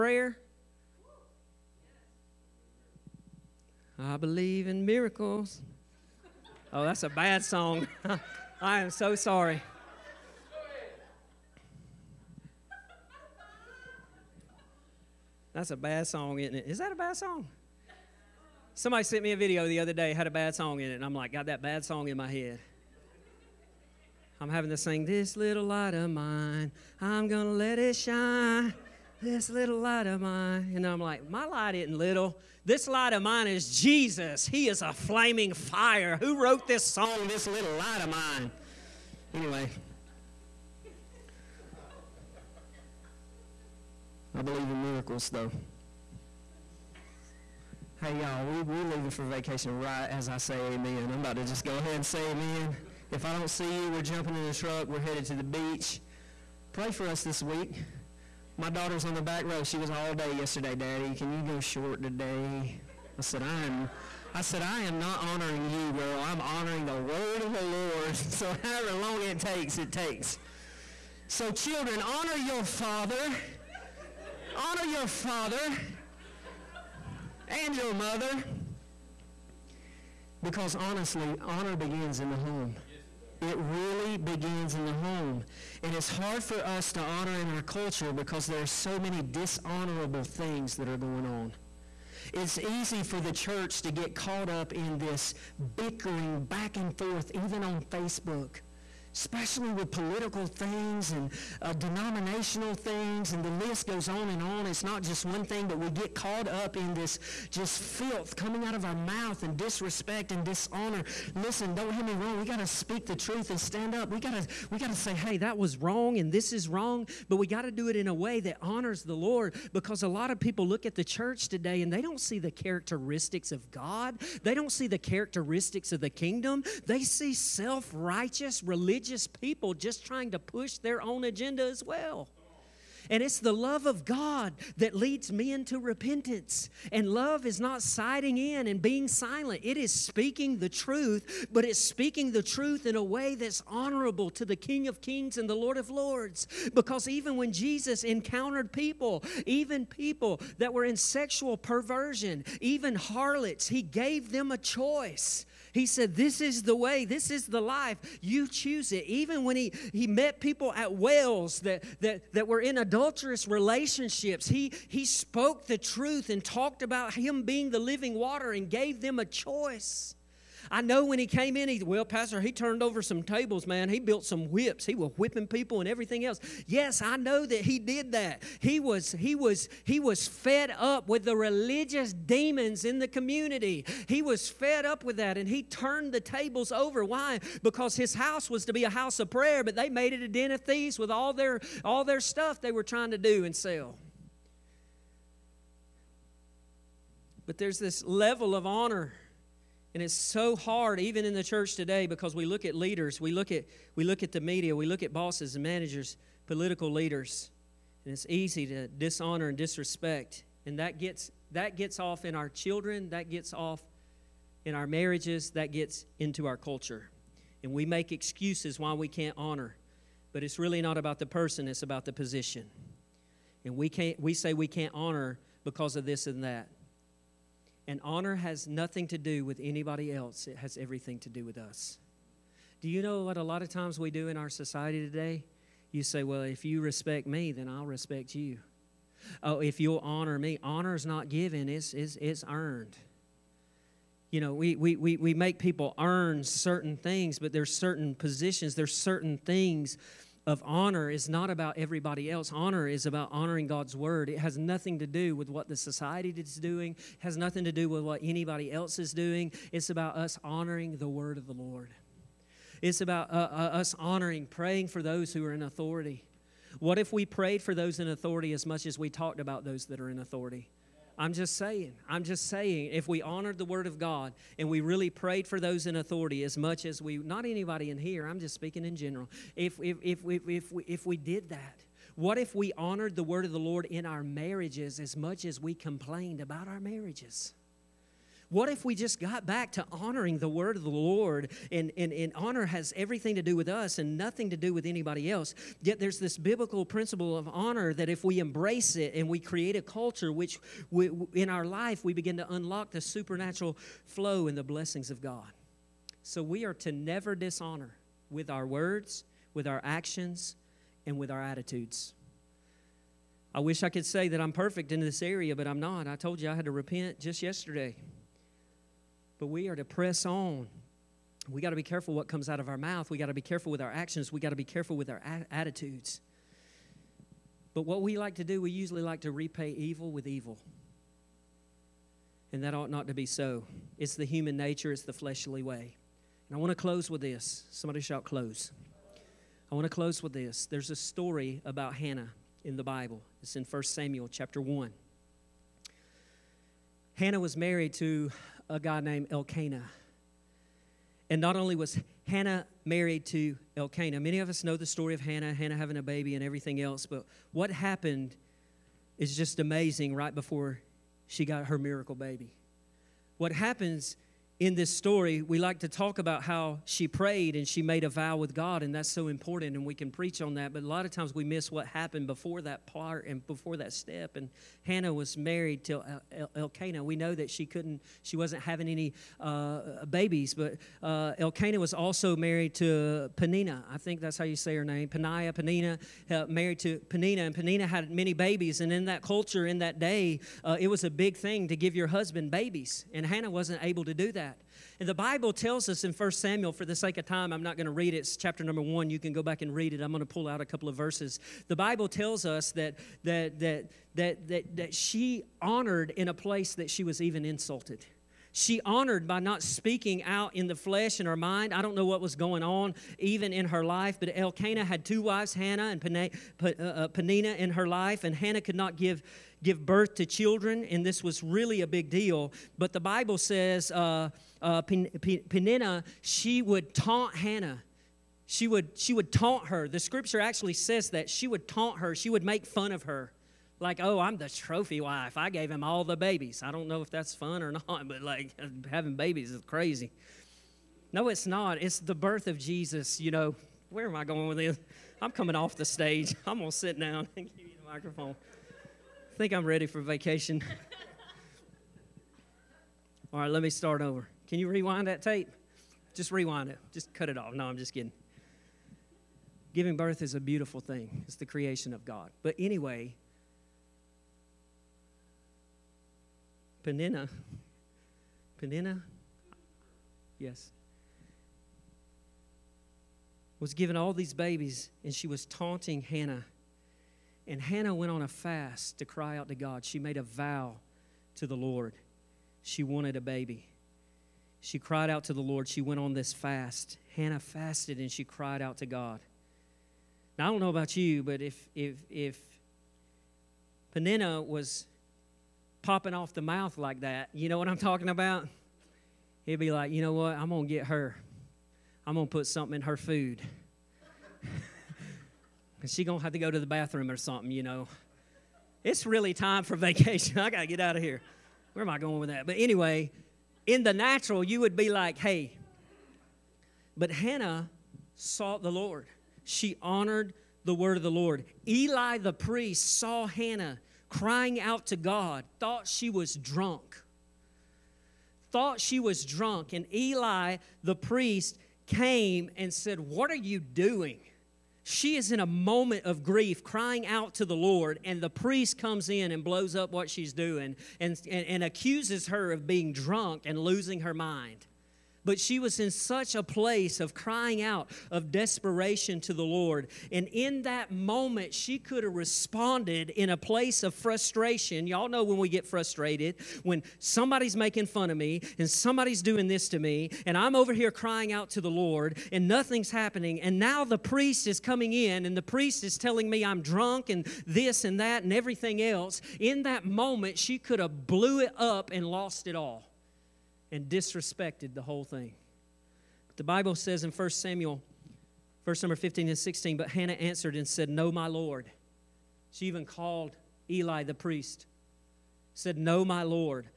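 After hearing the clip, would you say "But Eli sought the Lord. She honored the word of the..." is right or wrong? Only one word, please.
wrong.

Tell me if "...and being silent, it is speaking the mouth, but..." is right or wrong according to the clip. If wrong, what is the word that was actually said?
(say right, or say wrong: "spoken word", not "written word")
wrong: "truth", not "mouth".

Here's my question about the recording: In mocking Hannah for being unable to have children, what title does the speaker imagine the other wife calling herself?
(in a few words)
the trophy wife.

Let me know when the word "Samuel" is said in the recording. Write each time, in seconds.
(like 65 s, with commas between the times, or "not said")
343 s, 396 s, 577 s.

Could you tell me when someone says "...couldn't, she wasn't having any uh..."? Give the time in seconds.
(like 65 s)
377 s.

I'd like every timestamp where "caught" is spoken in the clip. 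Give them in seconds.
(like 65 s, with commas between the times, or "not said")
94 s, 106 s.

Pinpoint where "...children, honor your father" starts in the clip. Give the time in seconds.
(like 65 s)
71 s.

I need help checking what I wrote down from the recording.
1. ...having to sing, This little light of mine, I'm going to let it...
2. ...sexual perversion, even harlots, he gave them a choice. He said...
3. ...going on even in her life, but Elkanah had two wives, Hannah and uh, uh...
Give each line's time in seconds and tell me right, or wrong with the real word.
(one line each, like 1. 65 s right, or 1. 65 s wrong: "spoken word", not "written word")
1. 24 s right
2. 150 s right
3. 412 s right.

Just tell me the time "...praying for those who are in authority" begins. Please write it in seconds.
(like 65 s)
264 s.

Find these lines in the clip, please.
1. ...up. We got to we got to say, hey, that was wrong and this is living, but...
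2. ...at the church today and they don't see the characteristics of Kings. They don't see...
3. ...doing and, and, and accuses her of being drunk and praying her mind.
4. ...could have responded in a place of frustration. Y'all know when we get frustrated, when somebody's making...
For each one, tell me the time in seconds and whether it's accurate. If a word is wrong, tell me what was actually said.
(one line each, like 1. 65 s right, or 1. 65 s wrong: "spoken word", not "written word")
1. 113 s wrong: "wrong", not "living"
2. 120 s wrong: "God", not "Kings"
3. 540 s wrong: "losing", not "praying"
4. 551 s right.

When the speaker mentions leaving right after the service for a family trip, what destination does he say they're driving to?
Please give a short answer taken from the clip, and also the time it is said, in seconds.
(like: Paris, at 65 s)
the beach, at 55 s.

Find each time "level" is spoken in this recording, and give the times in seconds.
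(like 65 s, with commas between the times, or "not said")
198 s.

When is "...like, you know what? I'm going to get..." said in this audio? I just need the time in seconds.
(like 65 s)
499 s.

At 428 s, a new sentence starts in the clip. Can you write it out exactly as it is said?
She would, she would taunt her.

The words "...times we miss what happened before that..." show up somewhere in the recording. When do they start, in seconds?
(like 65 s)
371 s.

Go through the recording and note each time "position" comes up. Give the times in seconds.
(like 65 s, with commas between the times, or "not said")
222 s, 248 s.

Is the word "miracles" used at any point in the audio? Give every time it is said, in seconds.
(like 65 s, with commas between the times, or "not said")
4 s, 44 s, 361 s.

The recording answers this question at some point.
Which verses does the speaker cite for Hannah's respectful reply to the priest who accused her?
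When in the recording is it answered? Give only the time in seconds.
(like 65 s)
578 s.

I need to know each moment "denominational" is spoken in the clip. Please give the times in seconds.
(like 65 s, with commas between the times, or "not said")
101 s.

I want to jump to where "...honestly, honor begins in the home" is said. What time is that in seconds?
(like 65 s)
80 s.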